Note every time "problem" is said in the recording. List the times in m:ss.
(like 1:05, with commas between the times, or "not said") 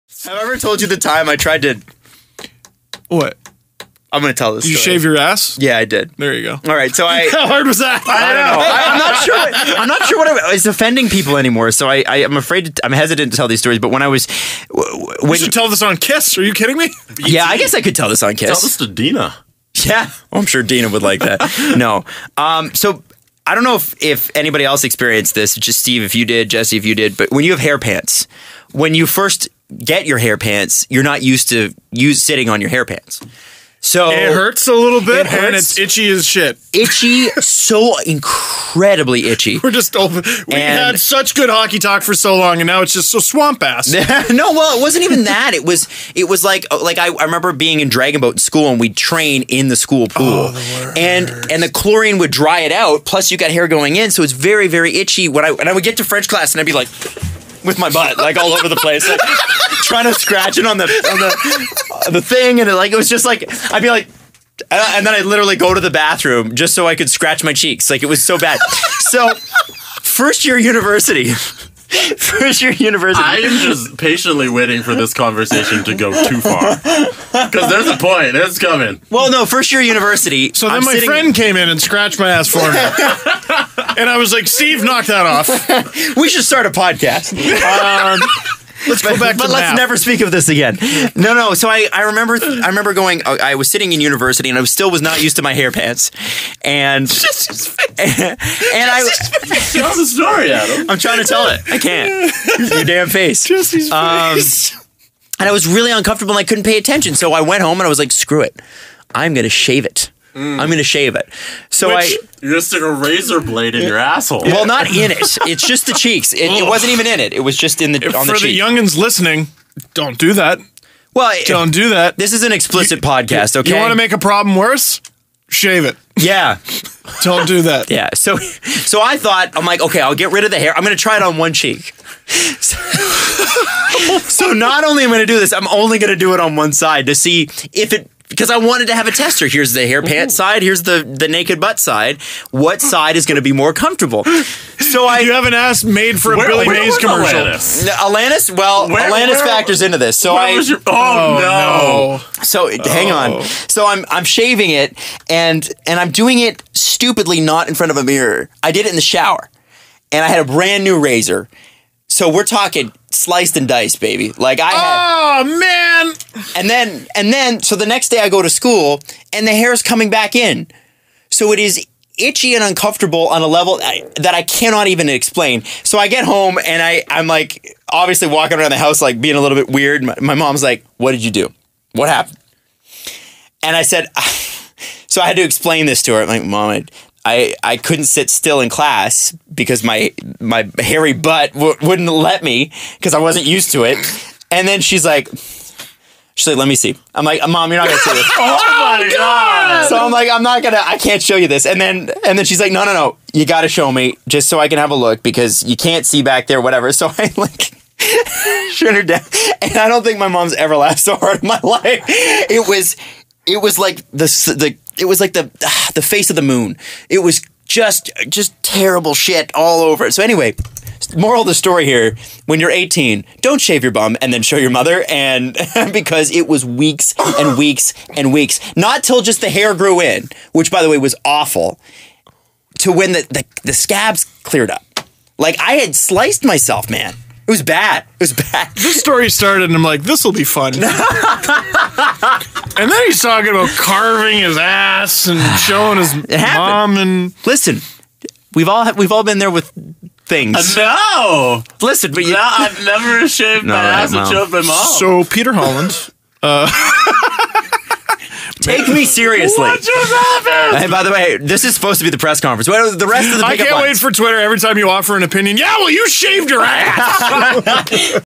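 2:04.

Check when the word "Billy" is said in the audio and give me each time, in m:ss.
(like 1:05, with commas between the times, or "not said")
2:26.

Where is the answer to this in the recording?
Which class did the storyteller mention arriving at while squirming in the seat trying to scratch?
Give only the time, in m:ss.
0:56.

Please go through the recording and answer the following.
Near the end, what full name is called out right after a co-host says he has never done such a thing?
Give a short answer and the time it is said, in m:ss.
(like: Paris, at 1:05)
Peter Holland, at 4:15.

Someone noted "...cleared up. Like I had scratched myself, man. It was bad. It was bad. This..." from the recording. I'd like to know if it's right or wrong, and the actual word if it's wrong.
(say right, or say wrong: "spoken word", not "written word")
wrong: "sliced", not "scratched".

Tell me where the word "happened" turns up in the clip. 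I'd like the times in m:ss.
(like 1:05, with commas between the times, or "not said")
3:02, 4:20.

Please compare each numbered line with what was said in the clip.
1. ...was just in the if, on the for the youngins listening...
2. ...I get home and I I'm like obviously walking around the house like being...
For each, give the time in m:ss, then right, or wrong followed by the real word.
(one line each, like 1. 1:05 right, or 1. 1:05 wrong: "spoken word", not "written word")
1. 1:57 right
2. 2:55 right.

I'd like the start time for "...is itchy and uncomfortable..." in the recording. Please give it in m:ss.
2:51.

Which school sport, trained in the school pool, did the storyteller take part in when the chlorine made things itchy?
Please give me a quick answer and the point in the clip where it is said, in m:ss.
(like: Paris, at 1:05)
Dragon Boat, at 0:47.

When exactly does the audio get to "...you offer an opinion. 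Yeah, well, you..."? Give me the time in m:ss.
4:24.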